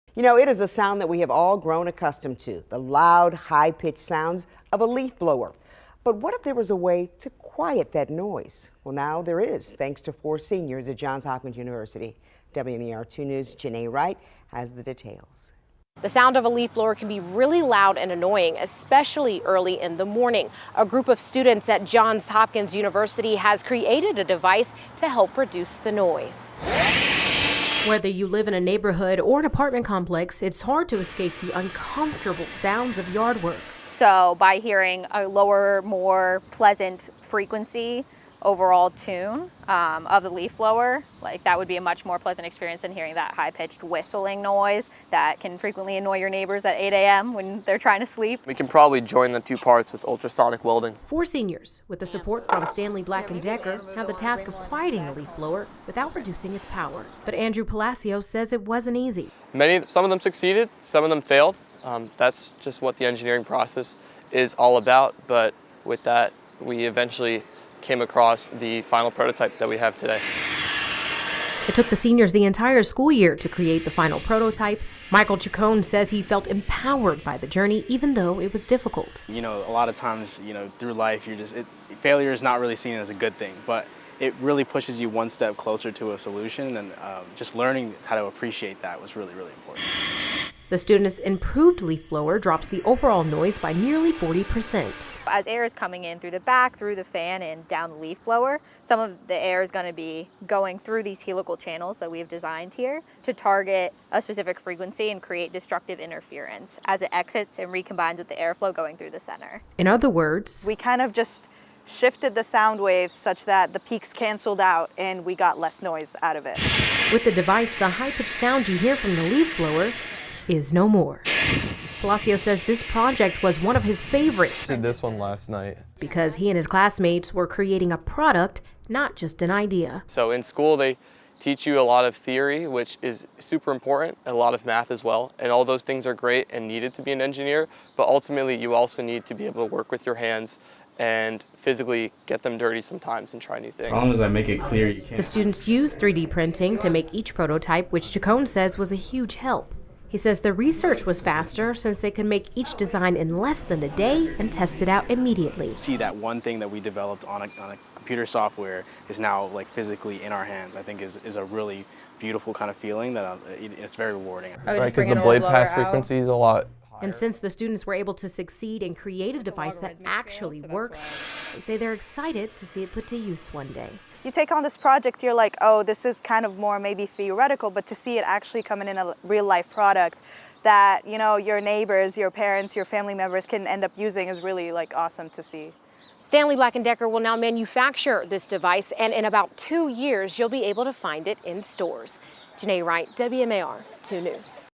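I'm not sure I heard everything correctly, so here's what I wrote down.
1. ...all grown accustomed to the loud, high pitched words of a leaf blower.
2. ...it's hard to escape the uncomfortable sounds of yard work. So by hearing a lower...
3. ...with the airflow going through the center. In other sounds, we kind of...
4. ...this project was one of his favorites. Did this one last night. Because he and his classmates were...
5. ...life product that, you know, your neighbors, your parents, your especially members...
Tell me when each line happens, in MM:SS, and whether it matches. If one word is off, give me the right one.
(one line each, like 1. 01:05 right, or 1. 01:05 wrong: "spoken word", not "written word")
1. 00:01 wrong: "sounds", not "words"
2. 00:30 right
3. 01:48 wrong: "words", not "sounds"
4. 02:02 right
5. 02:59 wrong: "family", not "especially".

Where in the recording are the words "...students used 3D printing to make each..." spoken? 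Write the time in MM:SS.
02:25.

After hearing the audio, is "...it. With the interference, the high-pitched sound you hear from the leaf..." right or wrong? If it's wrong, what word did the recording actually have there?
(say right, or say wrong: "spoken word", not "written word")
wrong: "device", not "interference".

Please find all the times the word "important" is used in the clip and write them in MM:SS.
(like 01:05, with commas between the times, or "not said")
01:29, 02:13.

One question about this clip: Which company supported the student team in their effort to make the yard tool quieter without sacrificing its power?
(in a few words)
Stanley Black and Decker.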